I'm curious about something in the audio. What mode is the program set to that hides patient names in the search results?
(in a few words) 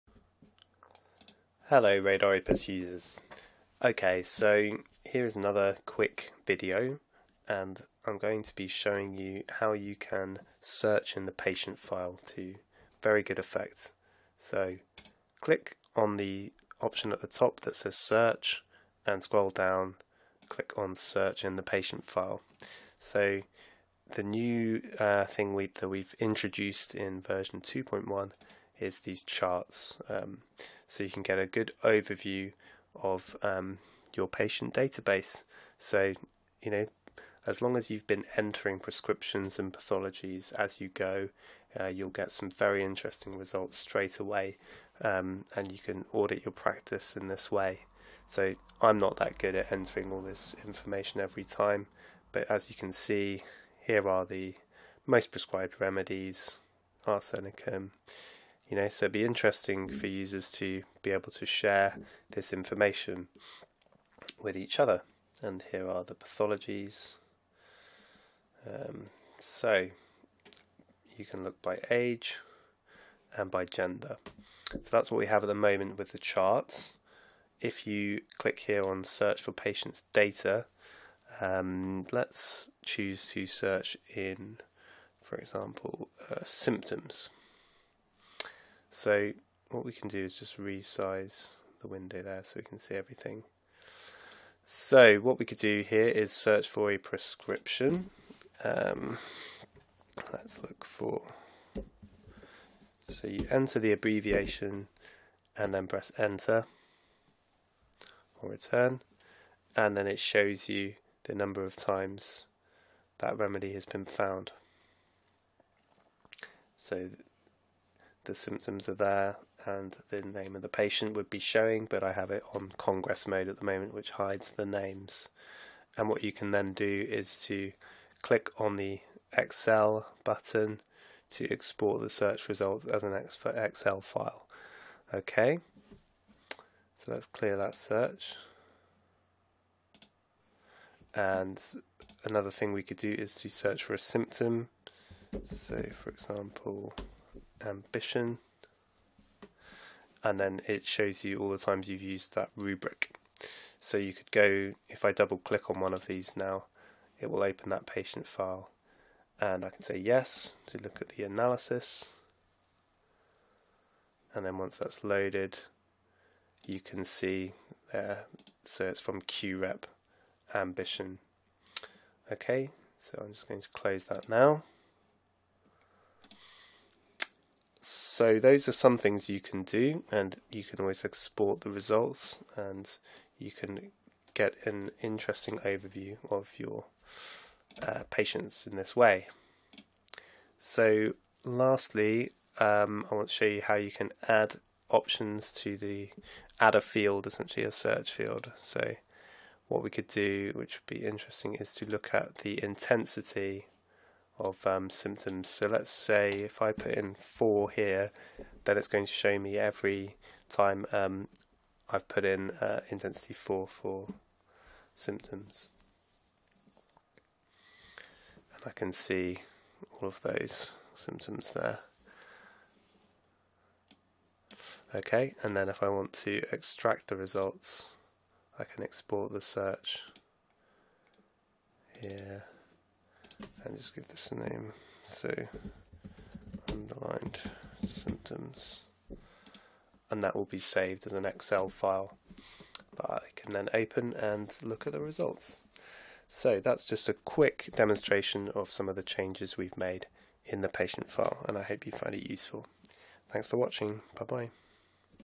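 Congress mode.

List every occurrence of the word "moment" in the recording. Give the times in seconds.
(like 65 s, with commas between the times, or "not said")
75 s, 123 s.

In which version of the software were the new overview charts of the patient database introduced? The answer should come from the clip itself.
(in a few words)
2.1.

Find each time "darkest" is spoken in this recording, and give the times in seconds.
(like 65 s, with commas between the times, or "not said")
not said.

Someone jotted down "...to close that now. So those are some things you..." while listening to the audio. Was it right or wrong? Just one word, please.
right.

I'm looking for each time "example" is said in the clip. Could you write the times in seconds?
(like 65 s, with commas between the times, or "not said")
85 s, 146 s.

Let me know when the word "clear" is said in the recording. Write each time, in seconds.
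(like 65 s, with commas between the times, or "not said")
137 s.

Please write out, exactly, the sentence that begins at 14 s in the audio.
So click on the option at the top that says search and scroll down, click on search in the patient file.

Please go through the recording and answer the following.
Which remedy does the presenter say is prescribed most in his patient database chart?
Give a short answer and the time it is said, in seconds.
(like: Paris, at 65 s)
Arsenicum, at 57 s.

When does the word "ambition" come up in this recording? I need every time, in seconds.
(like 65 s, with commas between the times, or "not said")
147 s, 170 s.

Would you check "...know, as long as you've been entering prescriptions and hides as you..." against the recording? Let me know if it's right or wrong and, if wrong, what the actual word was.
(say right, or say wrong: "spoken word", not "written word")
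wrong: "pathologies", not "hides".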